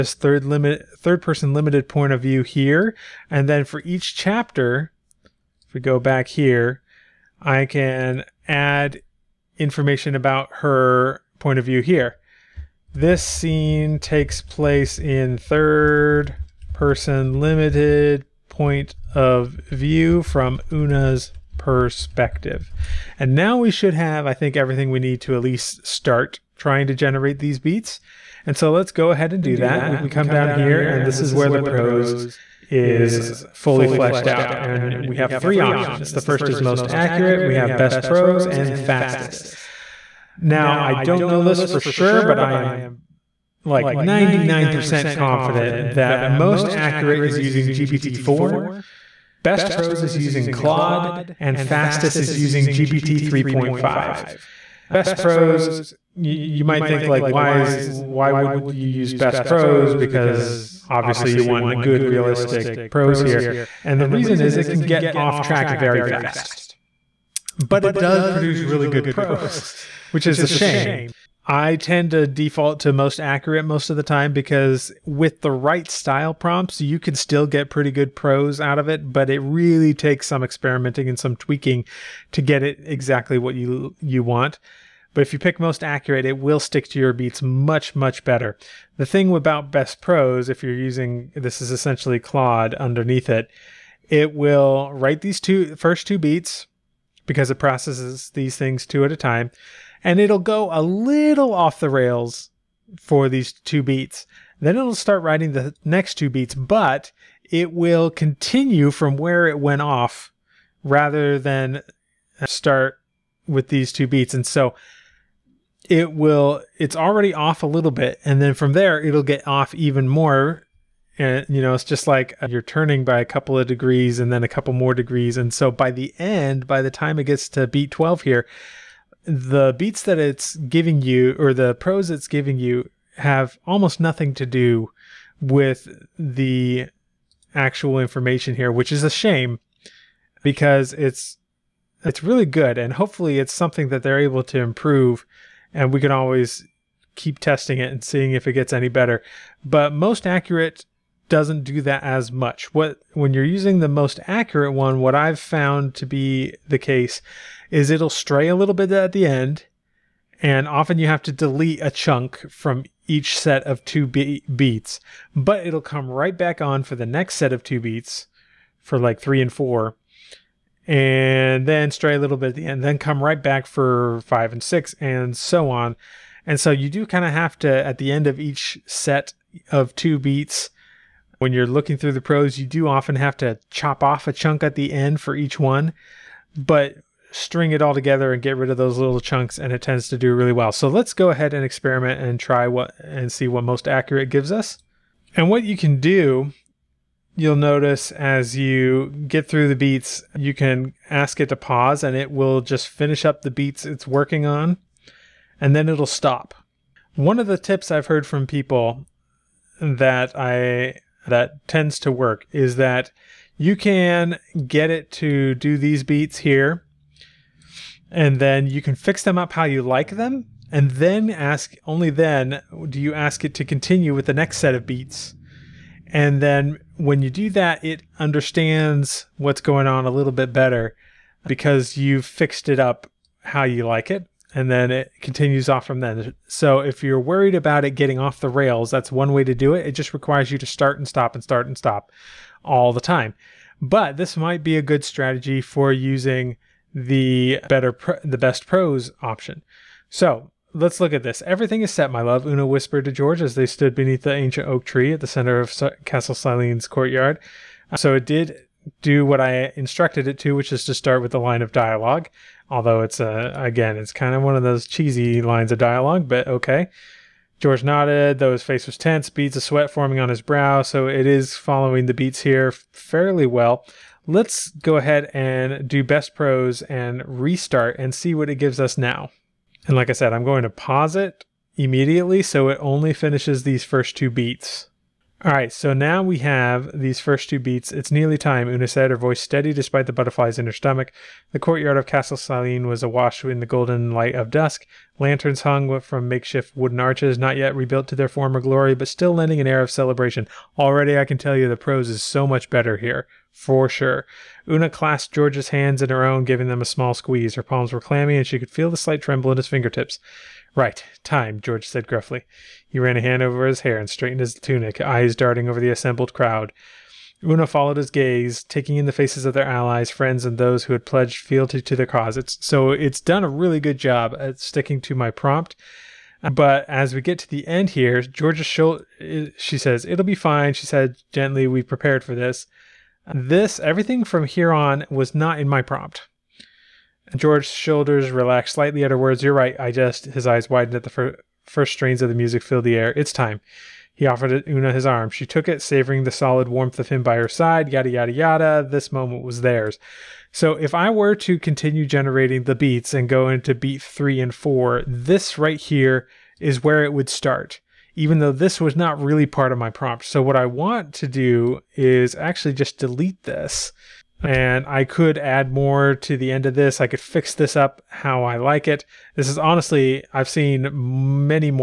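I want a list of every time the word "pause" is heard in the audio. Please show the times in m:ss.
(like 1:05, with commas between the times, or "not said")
3:21, 4:40.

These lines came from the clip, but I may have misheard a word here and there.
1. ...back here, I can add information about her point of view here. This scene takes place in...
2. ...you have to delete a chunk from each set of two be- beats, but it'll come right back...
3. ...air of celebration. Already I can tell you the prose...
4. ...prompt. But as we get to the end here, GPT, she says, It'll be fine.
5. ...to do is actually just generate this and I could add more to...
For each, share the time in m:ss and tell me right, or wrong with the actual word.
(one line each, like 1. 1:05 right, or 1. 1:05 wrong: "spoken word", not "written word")
1. 0:05 right
2. 2:40 right
3. 4:59 right
4. 5:25 wrong: "Georgia", not "GPT"
5. 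6:01 wrong: "delete", not "generate".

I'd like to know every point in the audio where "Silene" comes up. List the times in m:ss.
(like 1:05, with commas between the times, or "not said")
4:16, 4:52.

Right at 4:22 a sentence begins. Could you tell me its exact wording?
Although it's a again, it's kind of one of those cheesy lines of dialogue, but okay.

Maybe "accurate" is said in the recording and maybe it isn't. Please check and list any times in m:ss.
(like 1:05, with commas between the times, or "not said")
0:36, 0:46, 1:13, 1:25, 2:30, 2:34, 3:13.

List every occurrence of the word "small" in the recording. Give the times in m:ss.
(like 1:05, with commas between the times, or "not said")
5:06.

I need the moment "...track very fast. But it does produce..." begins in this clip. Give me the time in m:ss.
1:05.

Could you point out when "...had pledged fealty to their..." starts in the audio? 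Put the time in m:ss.
5:20.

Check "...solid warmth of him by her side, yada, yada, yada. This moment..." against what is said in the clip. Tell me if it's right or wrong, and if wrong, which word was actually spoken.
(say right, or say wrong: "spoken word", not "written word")
right.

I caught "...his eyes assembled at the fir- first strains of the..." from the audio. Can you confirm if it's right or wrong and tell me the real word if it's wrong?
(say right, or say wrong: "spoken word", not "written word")
wrong: "widened", not "assembled".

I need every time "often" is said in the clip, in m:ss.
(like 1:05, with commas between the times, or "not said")
2:40, 3:02.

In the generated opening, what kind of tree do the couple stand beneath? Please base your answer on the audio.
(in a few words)
ancient oak tree.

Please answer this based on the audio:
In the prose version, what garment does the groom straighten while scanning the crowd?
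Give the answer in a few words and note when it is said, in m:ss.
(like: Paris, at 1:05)
tunic, at 5:14.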